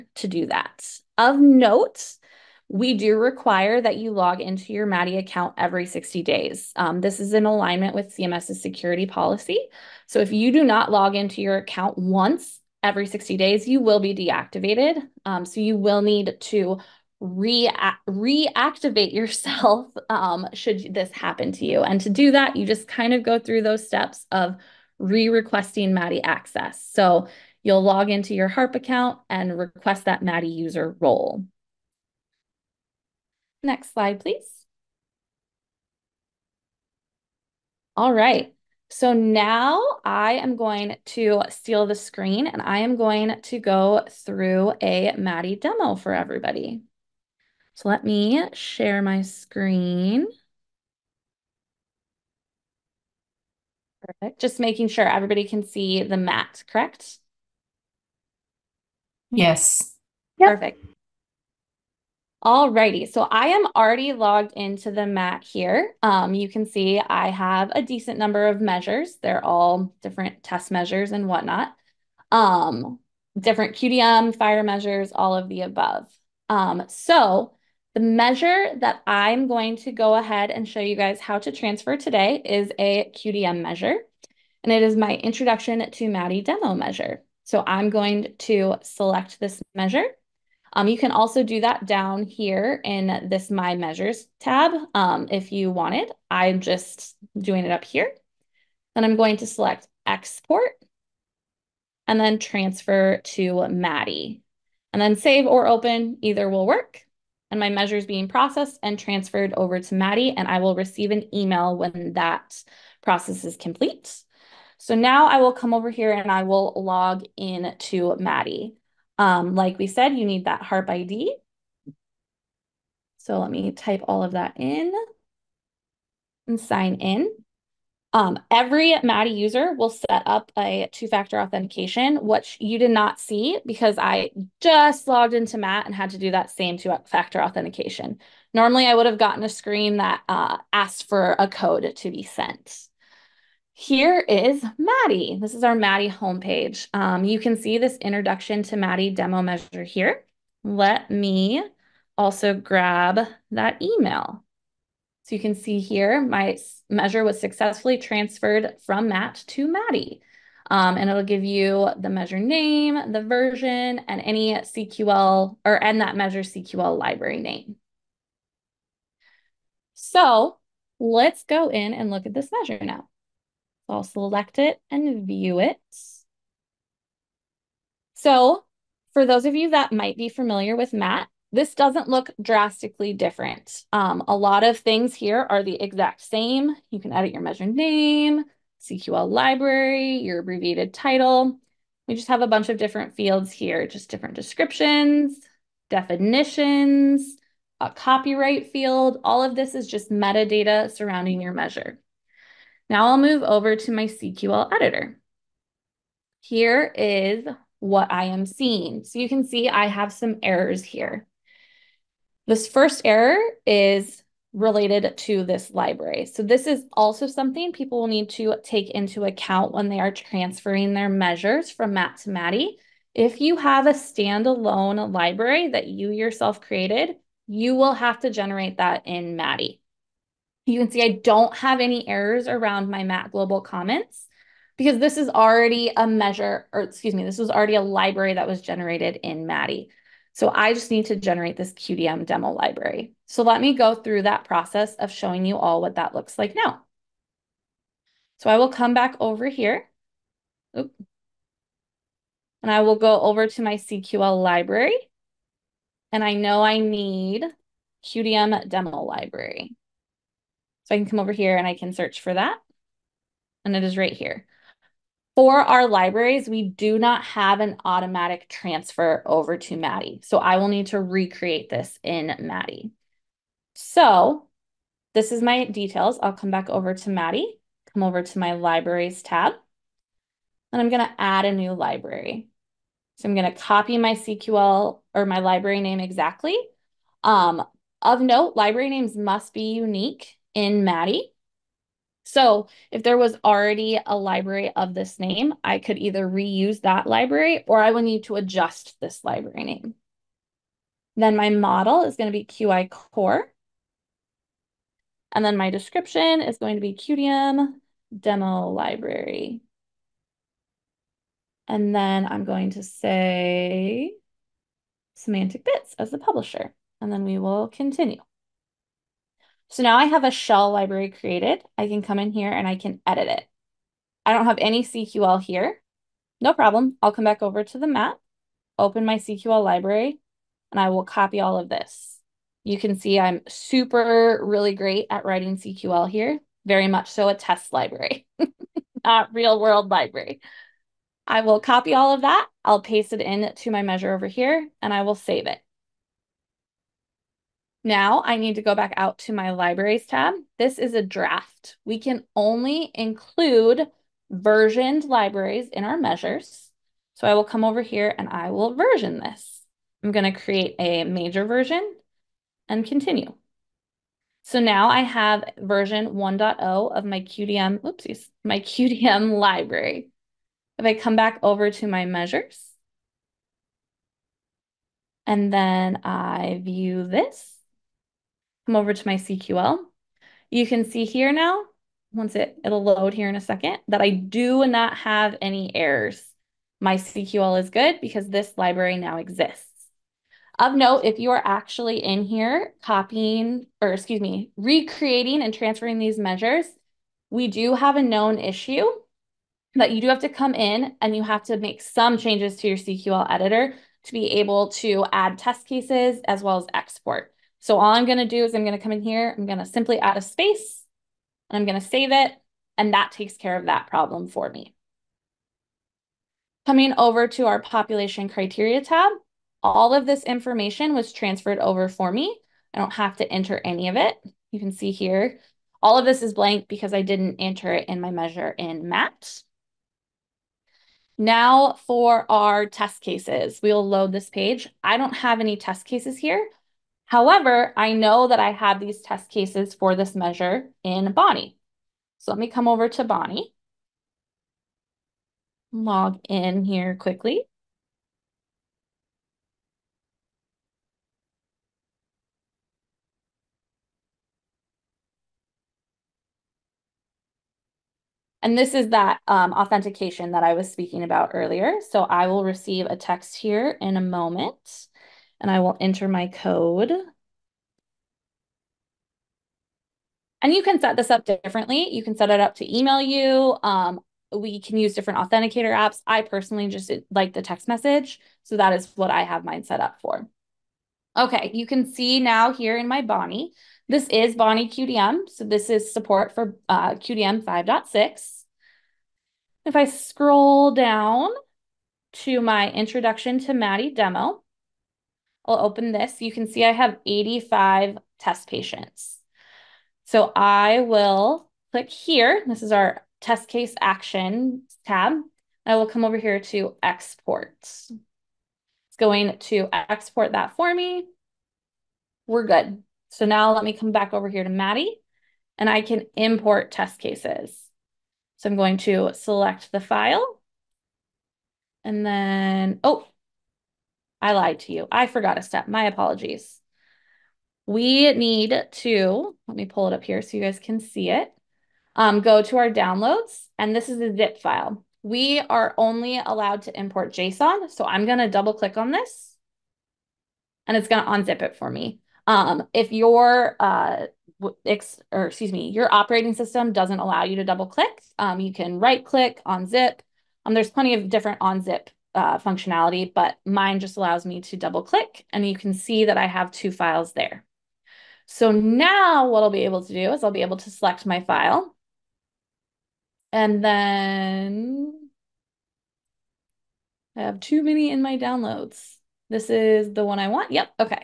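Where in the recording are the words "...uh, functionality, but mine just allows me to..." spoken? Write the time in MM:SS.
09:12.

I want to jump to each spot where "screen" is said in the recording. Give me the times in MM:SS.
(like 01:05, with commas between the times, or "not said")
00:41, 00:49, 02:19.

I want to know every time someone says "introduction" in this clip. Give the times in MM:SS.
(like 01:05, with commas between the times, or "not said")
01:25, 02:27, 08:12.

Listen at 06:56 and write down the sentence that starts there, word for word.
Coming over to our population criteria tab, all of this information was transferred over for me.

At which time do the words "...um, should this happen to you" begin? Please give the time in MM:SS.
00:20.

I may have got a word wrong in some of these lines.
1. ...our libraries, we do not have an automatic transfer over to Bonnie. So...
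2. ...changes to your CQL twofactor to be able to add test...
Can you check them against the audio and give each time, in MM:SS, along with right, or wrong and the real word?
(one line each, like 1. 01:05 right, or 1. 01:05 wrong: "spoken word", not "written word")
1. 04:25 wrong: "MADiE", not "Bonnie"
2. 06:42 wrong: "editor", not "twofactor".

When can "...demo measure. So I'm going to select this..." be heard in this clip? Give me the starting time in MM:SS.
01:26.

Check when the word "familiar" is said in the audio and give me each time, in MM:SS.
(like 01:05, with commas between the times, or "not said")
03:00.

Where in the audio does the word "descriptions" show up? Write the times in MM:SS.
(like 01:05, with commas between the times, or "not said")
03:14, 05:05.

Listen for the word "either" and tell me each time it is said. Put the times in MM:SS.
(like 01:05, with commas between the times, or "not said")
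01:46, 04:55.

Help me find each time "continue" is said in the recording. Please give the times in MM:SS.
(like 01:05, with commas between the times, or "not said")
05:17, 06:02.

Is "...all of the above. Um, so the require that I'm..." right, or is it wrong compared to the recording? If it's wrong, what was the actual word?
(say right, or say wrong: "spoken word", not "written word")
wrong: "measure", not "require".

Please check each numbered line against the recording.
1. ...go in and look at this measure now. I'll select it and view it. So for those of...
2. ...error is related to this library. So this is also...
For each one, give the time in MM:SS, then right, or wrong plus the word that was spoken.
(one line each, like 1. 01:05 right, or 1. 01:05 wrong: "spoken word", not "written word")
1. 02:51 right
2. 03:33 right.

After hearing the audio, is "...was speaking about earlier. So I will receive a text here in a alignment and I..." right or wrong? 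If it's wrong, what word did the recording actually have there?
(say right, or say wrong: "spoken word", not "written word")
wrong: "moment", not "alignment".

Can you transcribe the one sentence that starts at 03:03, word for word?
Um, a lot of things here are the exact same.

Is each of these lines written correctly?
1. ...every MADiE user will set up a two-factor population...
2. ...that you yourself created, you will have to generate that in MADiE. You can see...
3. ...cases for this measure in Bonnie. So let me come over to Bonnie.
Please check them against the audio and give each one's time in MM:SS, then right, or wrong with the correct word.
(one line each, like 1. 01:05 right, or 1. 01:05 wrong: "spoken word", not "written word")
1. 02:08 wrong: "authentication", not "population"
2. 03:45 right
3. 07:19 right.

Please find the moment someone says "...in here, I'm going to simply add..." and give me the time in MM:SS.
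06:48.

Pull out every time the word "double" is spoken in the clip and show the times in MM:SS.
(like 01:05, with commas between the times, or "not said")
08:58, 09:07, 09:14.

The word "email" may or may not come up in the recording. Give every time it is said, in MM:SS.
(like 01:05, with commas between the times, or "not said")
01:51, 02:33, 07:52.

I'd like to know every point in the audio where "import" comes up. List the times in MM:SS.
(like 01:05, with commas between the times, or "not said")
08:36, 08:56.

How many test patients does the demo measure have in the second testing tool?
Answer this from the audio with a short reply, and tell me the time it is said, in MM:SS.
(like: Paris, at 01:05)
85, at 08:17.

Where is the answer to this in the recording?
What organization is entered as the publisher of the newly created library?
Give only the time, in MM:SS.
05:15.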